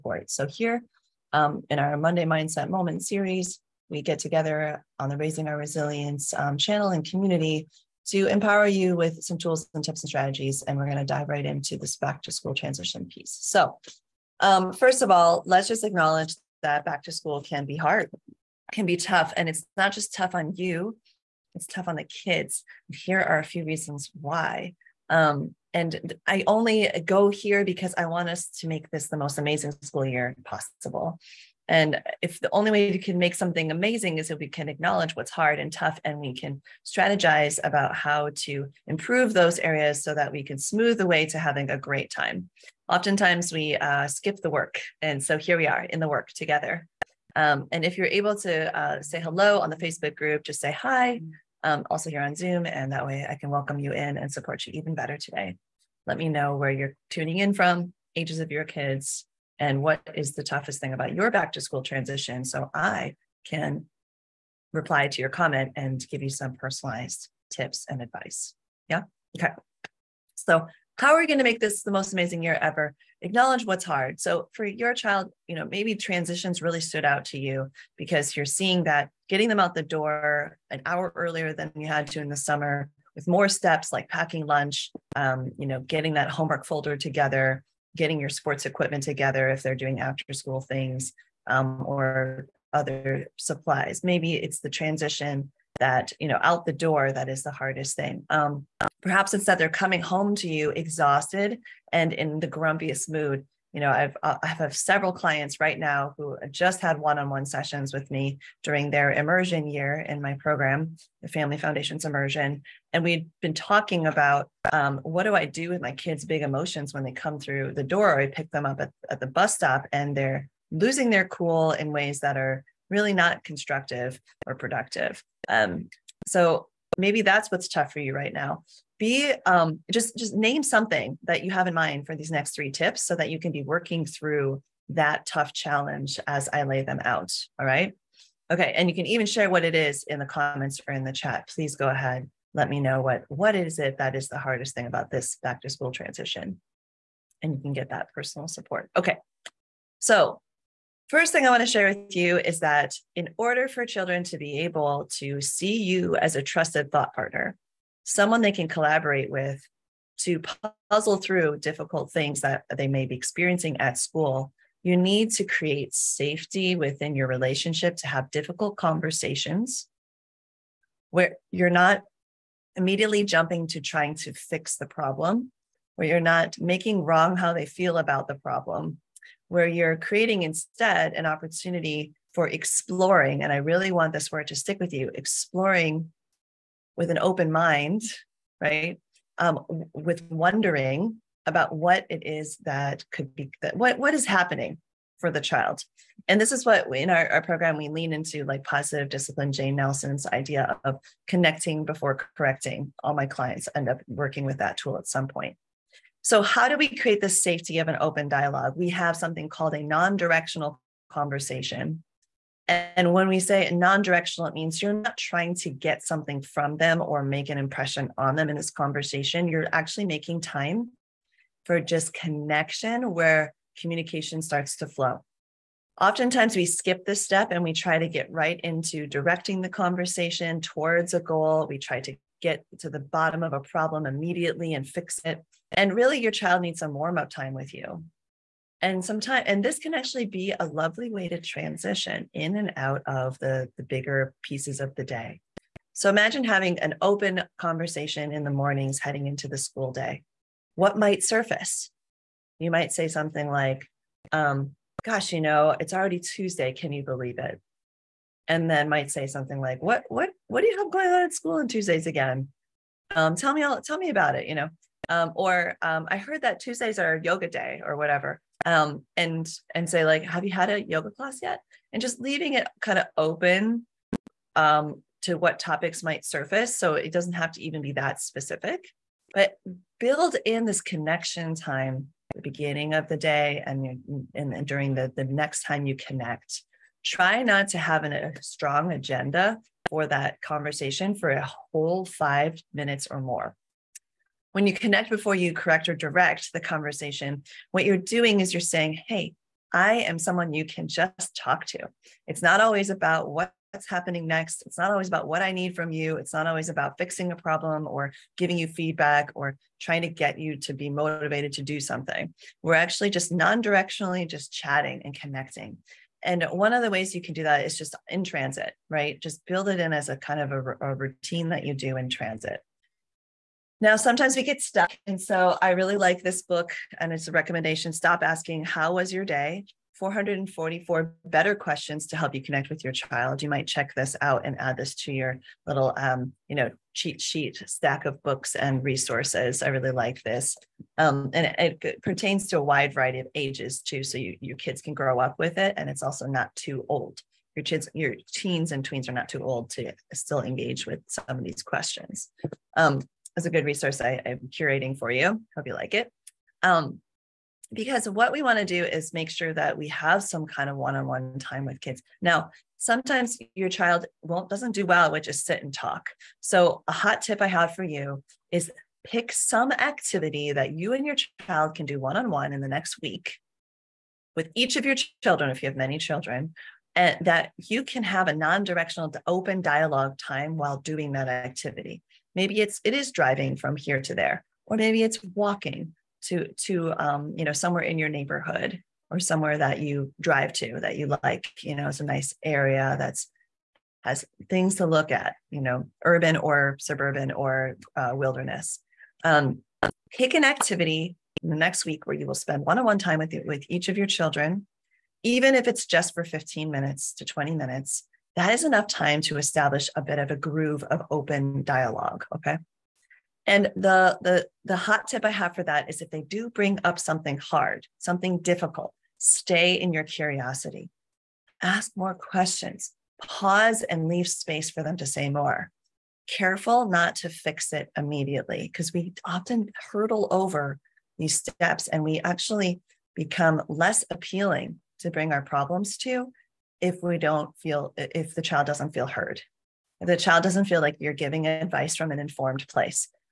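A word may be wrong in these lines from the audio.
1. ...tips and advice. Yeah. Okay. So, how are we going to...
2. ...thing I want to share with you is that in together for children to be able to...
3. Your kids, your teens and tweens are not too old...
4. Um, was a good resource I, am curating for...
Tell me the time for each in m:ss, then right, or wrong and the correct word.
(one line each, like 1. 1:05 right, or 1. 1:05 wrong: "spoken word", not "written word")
1. 1:07 right
2. 2:31 wrong: "order", not "together"
3. 5:47 right
4. 5:52 right.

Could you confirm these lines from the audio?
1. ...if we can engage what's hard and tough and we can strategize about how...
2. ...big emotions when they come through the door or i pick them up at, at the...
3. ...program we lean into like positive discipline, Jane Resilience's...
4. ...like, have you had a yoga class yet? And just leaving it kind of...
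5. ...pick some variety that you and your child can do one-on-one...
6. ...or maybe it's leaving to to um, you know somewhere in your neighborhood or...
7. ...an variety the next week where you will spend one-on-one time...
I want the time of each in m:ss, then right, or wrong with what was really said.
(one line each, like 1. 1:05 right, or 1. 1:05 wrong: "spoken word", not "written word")
1. 0:34 wrong: "acknowledge", not "engage"
2. 1:56 right
3. 3:17 wrong: "Nelsen", not "Resilience"
4. 4:30 right
5. 6:09 wrong: "activity", not "variety"
6. 6:24 wrong: "walking", not "leaving"
7. 6:40 wrong: "activity", not "variety".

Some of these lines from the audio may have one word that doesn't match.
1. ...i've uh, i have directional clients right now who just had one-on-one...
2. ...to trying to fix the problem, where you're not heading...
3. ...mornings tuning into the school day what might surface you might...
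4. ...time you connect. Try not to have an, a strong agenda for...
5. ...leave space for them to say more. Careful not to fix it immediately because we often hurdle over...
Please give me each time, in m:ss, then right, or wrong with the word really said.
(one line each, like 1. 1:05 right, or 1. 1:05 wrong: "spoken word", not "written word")
1. 1:43 wrong: "several", not "directional"
2. 2:53 wrong: "making", not "heading"
3. 4:08 wrong: "heading", not "tuning"
4. 4:45 right
5. 7:04 right.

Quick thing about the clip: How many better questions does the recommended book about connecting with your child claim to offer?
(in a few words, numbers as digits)
444.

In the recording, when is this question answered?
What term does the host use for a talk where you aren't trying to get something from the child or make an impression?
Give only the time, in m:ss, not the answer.
3:29.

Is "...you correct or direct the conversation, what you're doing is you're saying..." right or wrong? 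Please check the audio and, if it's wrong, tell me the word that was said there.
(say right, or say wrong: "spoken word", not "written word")
right.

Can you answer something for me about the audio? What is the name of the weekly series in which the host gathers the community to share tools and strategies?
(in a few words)
Monday Mindset Moment.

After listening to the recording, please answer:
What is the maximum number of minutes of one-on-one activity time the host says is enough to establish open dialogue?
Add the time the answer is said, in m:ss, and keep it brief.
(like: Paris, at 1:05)
20, at 6:47.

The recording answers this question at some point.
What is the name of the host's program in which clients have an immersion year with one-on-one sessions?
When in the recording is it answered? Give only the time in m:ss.
1:51.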